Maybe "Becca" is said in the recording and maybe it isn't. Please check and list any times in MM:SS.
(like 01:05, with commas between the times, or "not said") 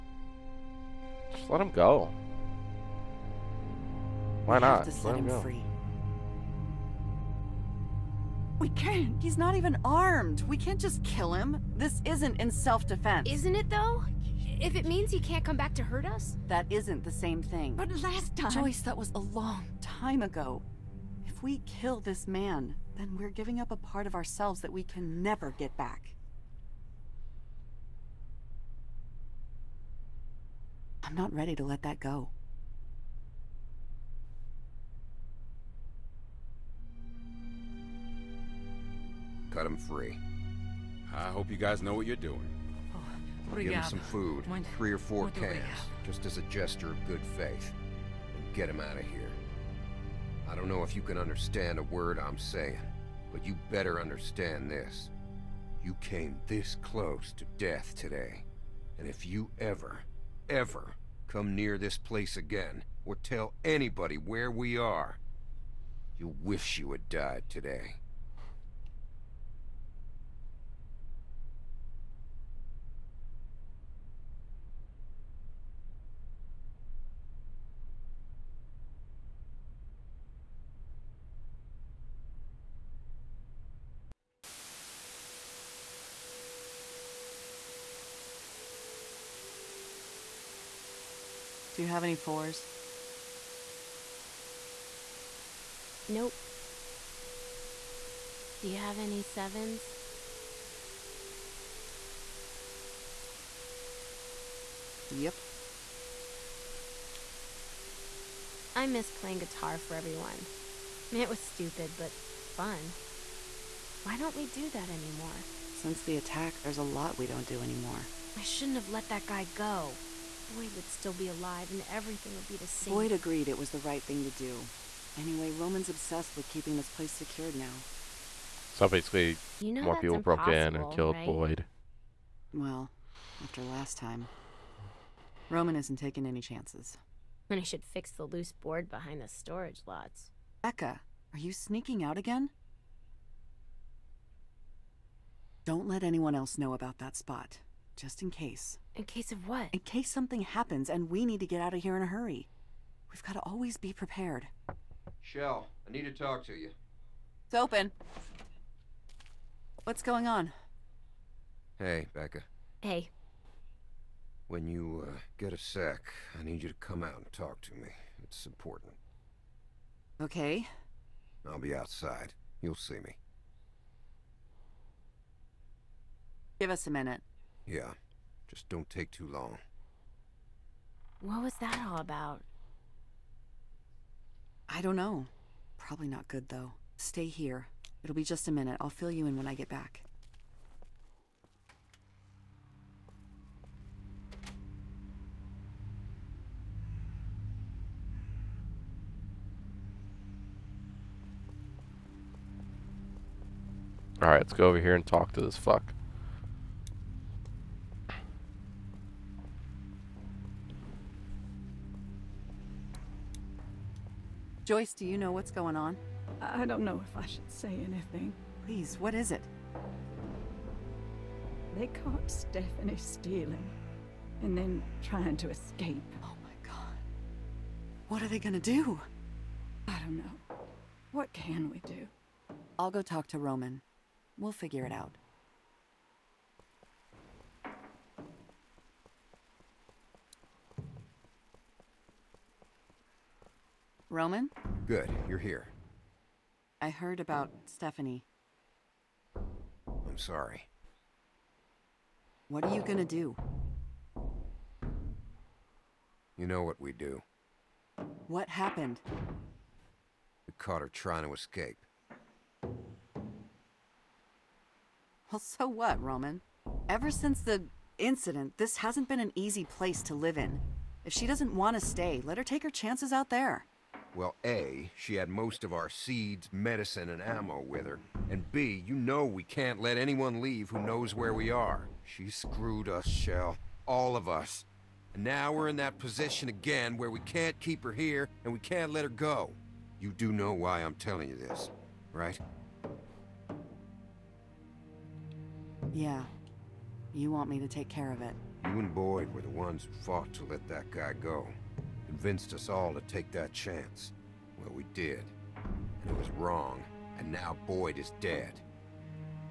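02:20, 02:42.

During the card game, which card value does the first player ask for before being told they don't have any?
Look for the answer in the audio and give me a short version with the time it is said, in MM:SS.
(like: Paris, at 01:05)
Fours, at 01:32.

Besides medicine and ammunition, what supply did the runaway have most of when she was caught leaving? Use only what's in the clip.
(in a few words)
Seeds.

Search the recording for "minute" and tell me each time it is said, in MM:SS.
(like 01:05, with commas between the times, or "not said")
02:56, 03:08.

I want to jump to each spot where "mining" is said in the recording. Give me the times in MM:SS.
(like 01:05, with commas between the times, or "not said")
not said.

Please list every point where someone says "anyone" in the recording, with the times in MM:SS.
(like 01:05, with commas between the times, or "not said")
02:26, 04:39.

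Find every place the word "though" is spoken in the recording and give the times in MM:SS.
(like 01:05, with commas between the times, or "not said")
00:13, 03:06.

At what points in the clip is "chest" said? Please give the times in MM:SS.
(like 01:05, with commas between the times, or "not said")
not said.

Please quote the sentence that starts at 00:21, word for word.
If we kill this man, then we're giving up a part of ourselves that we can never get back.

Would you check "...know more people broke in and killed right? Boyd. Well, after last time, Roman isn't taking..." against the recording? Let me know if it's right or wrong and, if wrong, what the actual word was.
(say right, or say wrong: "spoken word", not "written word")
right.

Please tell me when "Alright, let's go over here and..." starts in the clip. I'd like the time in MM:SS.
03:24.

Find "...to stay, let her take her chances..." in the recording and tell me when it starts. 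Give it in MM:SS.
04:31.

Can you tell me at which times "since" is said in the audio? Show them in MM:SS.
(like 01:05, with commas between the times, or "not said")
01:55, 04:27.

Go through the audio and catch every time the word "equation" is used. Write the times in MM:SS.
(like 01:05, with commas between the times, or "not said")
not said.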